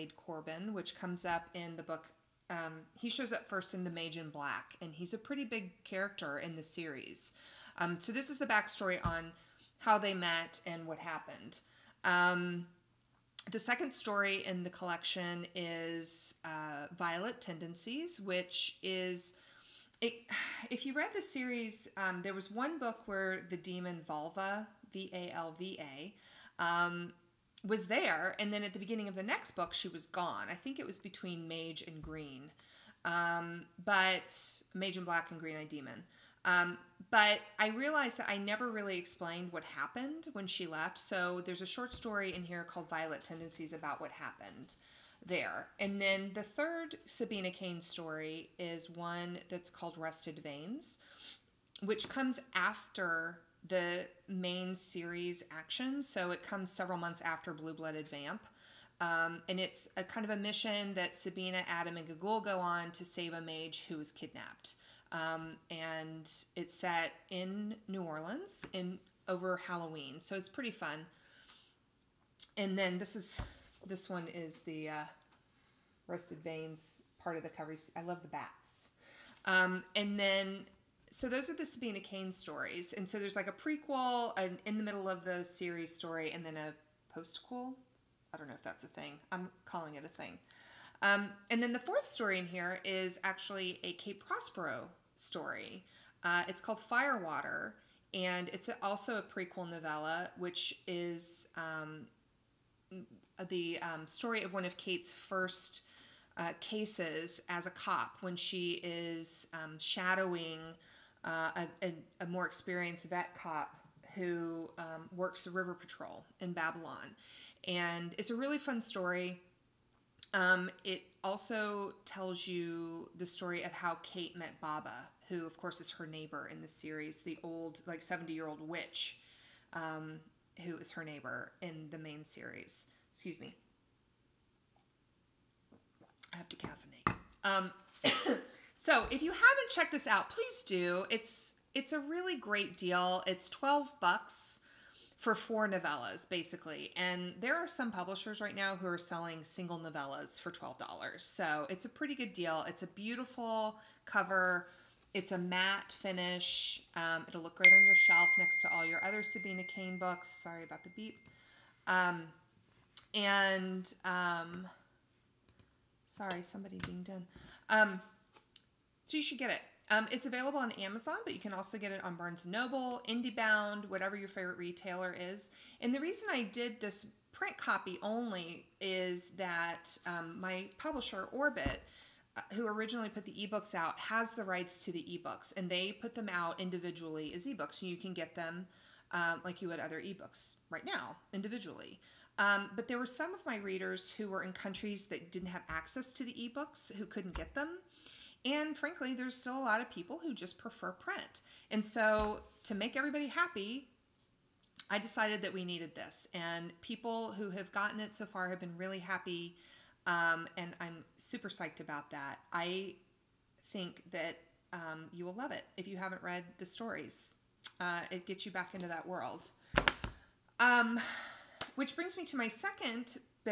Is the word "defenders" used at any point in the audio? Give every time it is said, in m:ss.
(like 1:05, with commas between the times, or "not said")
not said.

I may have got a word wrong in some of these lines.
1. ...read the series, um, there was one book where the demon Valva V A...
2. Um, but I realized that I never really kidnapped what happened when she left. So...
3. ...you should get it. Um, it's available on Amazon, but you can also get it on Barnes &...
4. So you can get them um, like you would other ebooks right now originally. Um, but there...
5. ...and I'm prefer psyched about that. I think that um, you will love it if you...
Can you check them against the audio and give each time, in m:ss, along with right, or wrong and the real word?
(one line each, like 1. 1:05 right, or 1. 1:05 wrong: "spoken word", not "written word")
1. 0:20 right
2. 0:36 wrong: "explained", not "kidnapped"
3. 2:49 right
4. 3:07 wrong: "individually", not "originally"
5. 3:30 wrong: "super", not "prefer".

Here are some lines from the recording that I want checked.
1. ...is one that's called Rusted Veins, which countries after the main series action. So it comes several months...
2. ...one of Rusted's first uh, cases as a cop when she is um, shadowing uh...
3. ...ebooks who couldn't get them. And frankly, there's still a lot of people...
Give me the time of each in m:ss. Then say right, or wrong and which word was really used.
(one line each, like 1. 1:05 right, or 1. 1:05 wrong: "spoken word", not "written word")
1. 0:48 wrong: "comes", not "countries"
2. 1:44 wrong: "Kate", not "Rusted"
3. 3:16 right.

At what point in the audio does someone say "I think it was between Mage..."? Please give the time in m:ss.
0:30.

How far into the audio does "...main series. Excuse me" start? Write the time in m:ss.
2:11.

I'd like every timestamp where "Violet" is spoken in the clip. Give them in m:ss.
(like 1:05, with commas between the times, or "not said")
0:16, 0:42.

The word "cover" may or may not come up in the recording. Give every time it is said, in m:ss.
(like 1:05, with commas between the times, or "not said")
1:17, 2:34.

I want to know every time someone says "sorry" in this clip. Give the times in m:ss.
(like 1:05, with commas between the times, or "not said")
2:40, 2:46.